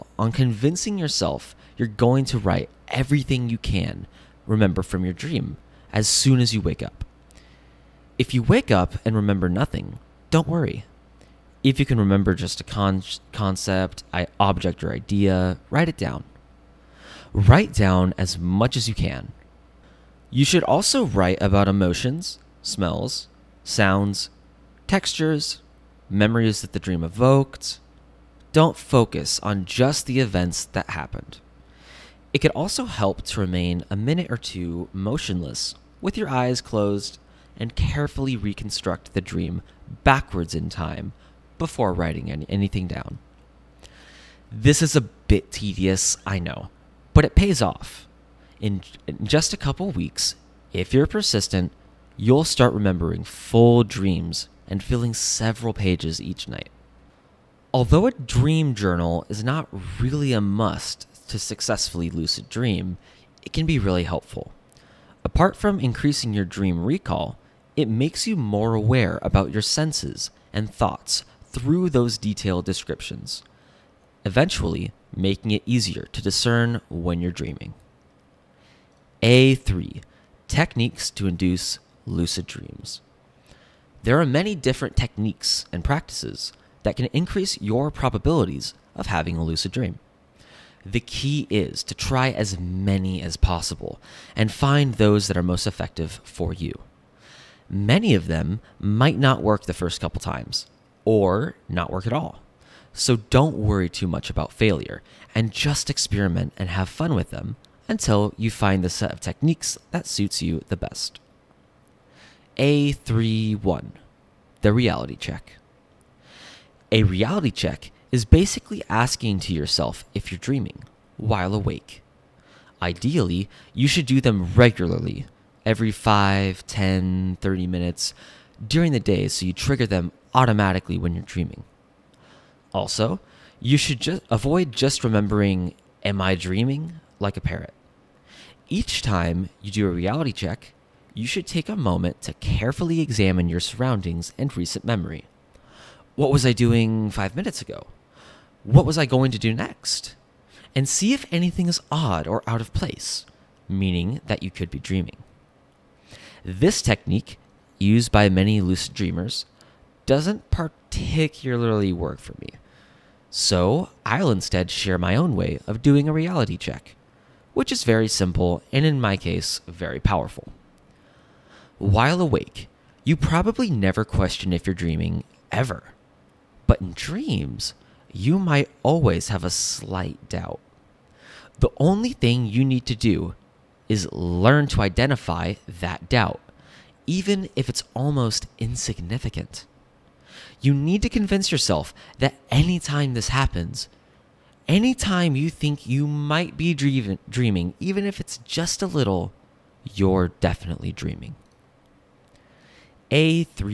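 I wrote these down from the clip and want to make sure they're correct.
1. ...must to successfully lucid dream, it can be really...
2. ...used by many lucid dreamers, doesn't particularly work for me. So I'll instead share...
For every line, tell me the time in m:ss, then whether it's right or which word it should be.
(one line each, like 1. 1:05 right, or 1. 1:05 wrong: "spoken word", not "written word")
1. 1:00 right
2. 2:37 right.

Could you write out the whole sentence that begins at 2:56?
But in dreams, you might always have a slight doubt.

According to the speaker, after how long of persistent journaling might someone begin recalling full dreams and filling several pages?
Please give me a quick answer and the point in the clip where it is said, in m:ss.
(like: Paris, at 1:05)
a couple weeks, at 0:49.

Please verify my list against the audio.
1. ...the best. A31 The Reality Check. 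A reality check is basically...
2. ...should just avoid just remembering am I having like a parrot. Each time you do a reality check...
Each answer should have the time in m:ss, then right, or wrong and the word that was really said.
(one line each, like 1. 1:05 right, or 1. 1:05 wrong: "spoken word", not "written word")
1. 1:50 right
2. 2:13 wrong: "dreaming", not "having".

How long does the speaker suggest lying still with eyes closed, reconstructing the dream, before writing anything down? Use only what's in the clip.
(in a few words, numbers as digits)
a minute or two.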